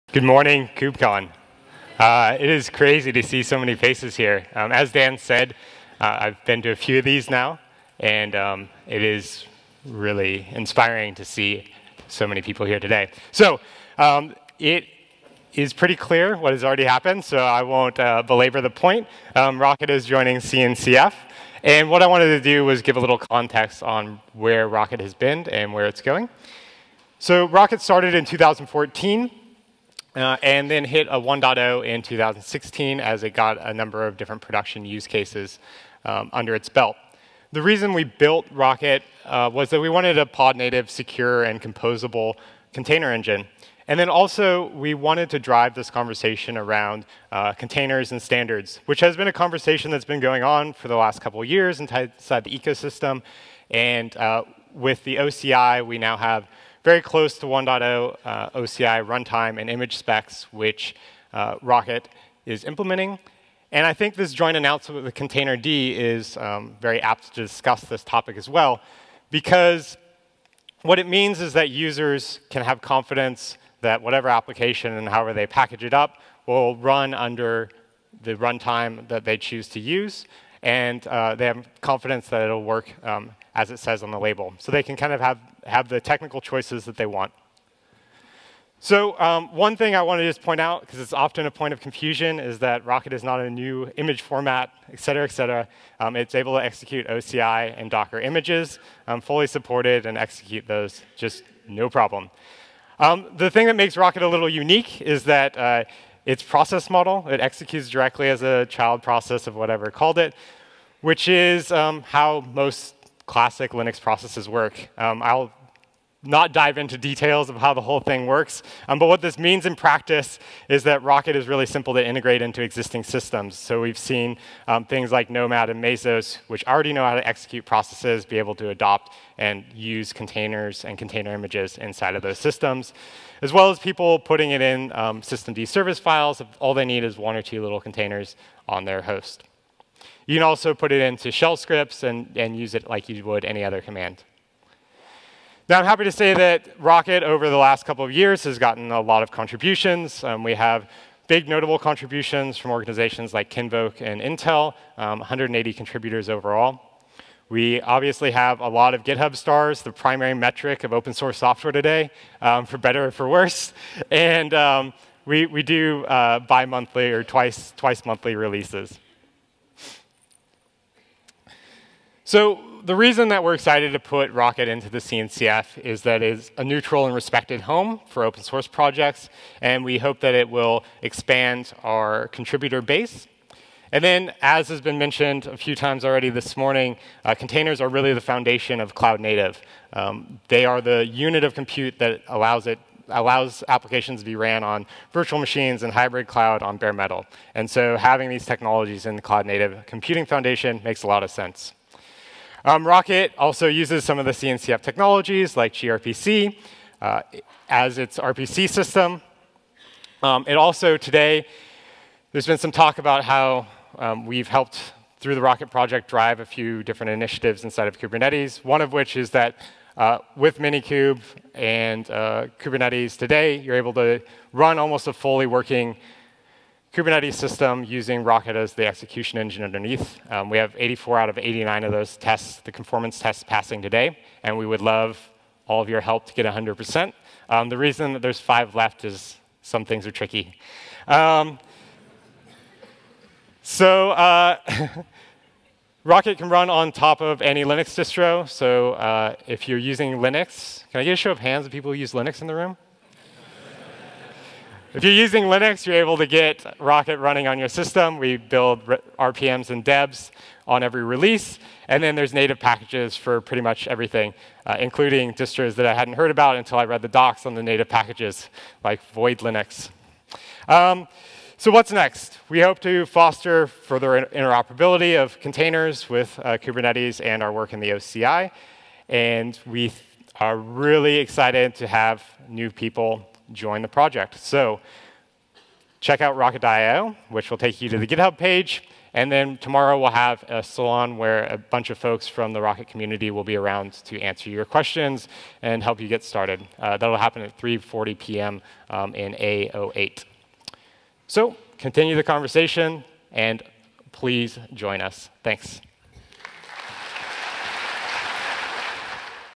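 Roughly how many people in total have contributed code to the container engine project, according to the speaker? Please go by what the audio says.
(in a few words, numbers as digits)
180.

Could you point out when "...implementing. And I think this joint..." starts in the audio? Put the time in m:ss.
1:02.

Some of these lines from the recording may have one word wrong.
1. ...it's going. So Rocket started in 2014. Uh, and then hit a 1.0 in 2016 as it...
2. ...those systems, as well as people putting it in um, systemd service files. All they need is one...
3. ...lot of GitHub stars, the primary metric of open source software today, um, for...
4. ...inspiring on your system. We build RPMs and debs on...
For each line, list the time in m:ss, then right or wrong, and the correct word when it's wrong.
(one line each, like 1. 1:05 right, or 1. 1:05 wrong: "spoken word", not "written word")
1. 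0:25 right
2. 2:12 right
3. 2:38 right
4. 4:17 wrong: "running", not "inspiring".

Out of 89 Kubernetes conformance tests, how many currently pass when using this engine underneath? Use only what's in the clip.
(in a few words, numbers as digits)
84.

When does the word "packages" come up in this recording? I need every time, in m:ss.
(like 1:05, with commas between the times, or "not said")
1:15, 4:22, 4:27.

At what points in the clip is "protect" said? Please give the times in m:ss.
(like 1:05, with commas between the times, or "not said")
not said.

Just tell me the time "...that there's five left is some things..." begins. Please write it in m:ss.
3:58.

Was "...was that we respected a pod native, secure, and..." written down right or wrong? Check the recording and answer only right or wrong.
wrong.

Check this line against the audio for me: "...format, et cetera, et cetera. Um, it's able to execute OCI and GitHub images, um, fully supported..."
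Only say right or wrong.
wrong.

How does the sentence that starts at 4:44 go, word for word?
So check out Rocket.io, which will take you to the GitHub page.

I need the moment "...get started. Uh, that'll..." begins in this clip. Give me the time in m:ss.
4:56.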